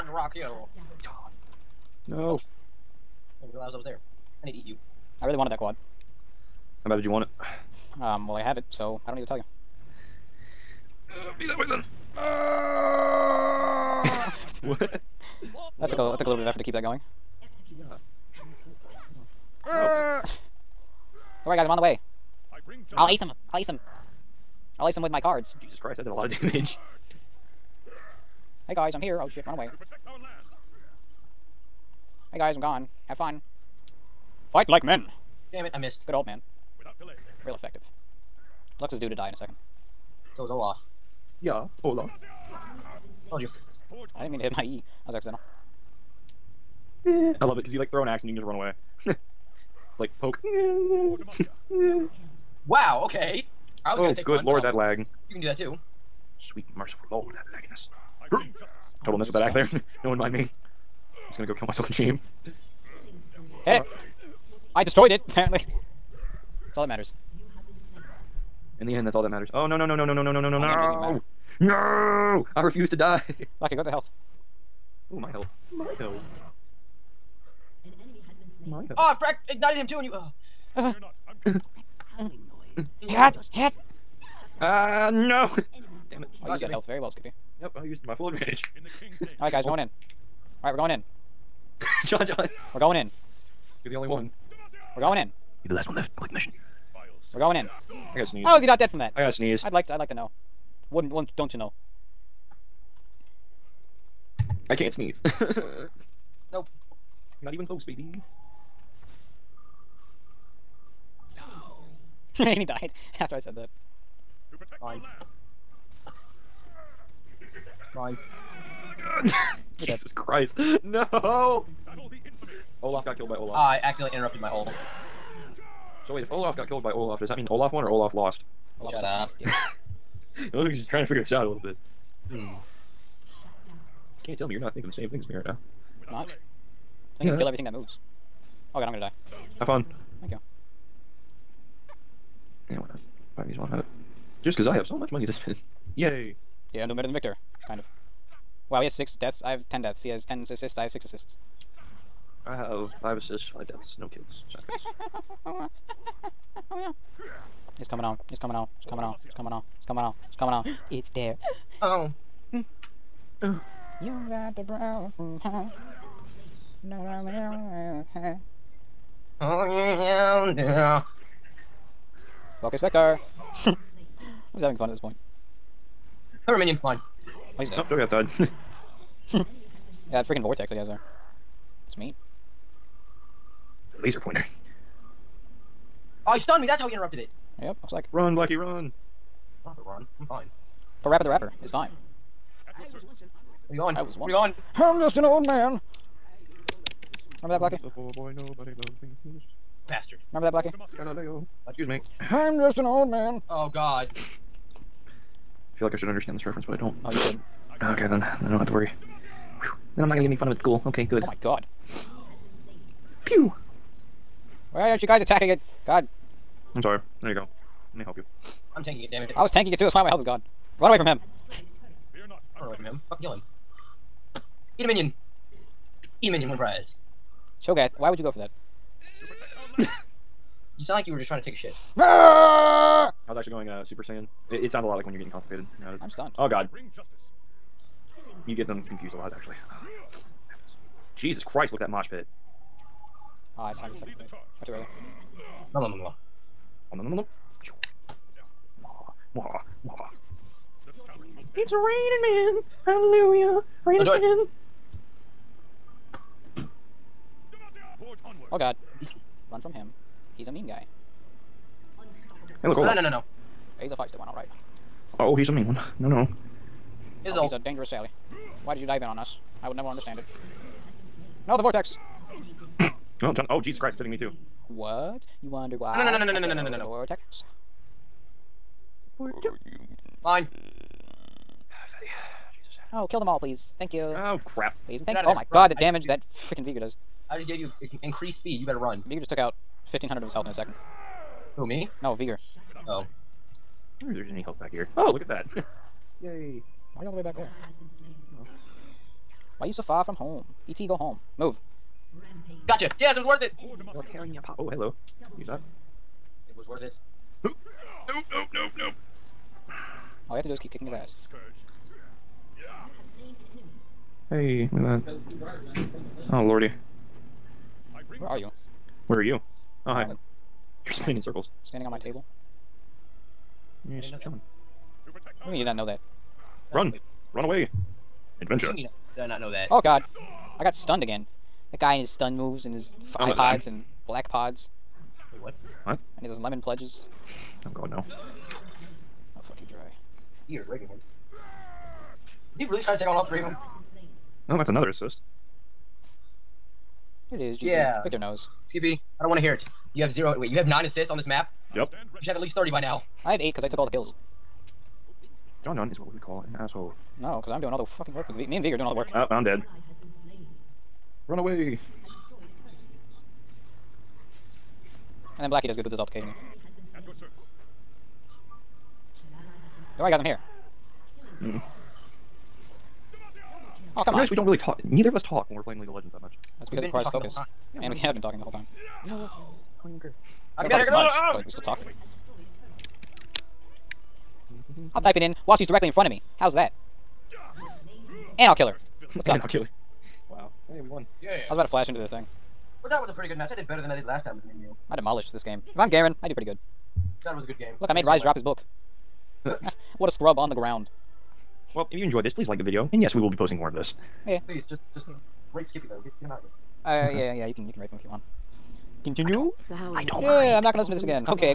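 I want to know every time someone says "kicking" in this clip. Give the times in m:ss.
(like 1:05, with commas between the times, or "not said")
5:10.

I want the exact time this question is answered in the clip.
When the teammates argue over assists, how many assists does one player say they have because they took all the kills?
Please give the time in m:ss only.
5:53.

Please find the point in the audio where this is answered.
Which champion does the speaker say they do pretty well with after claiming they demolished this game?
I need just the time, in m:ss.
6:35.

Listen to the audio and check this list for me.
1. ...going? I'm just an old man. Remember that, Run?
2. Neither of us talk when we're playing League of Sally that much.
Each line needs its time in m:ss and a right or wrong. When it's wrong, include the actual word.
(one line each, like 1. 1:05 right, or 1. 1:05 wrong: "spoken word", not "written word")
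1. 3:14 wrong: "Blackie", not "Run"
2. 6:14 wrong: "Legends", not "Sally".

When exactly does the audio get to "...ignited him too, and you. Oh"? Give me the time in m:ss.
1:19.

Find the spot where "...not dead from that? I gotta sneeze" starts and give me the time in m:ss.
1:38.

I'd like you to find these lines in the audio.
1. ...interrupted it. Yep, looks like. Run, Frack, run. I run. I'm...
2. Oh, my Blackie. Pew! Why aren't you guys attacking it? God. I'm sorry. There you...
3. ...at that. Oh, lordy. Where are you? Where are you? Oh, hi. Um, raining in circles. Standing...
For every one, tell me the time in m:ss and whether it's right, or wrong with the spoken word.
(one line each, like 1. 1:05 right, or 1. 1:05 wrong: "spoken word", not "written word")
1. 3:06 wrong: "Blackie", not "Frack"
2. 3:31 wrong: "God", not "Blackie"
3. 5:14 wrong: "spinning", not "raining".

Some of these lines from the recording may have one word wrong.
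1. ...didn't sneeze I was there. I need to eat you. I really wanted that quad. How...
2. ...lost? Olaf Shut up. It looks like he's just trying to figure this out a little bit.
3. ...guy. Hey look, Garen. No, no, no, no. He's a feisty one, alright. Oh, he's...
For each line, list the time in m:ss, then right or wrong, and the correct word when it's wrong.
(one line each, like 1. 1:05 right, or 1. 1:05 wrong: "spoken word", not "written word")
1. 0:03 wrong: "realize", not "sneeze"
2. 2:08 right
3. 4:20 wrong: "Olaf", not "Garen".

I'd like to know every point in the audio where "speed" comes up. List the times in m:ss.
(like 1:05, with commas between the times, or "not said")
4:48.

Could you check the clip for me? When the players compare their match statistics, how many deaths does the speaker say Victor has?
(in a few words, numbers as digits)
6.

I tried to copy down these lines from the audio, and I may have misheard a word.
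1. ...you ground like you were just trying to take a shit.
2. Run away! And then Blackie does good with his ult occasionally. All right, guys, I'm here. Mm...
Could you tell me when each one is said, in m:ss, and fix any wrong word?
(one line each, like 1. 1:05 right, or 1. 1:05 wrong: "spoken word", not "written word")
1. 3:50 wrong: "sound", not "ground"
2. 6:01 right.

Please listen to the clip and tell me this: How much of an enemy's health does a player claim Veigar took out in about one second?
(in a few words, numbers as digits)
1,500.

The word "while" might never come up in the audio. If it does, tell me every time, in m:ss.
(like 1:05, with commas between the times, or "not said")
2:23, 6:25.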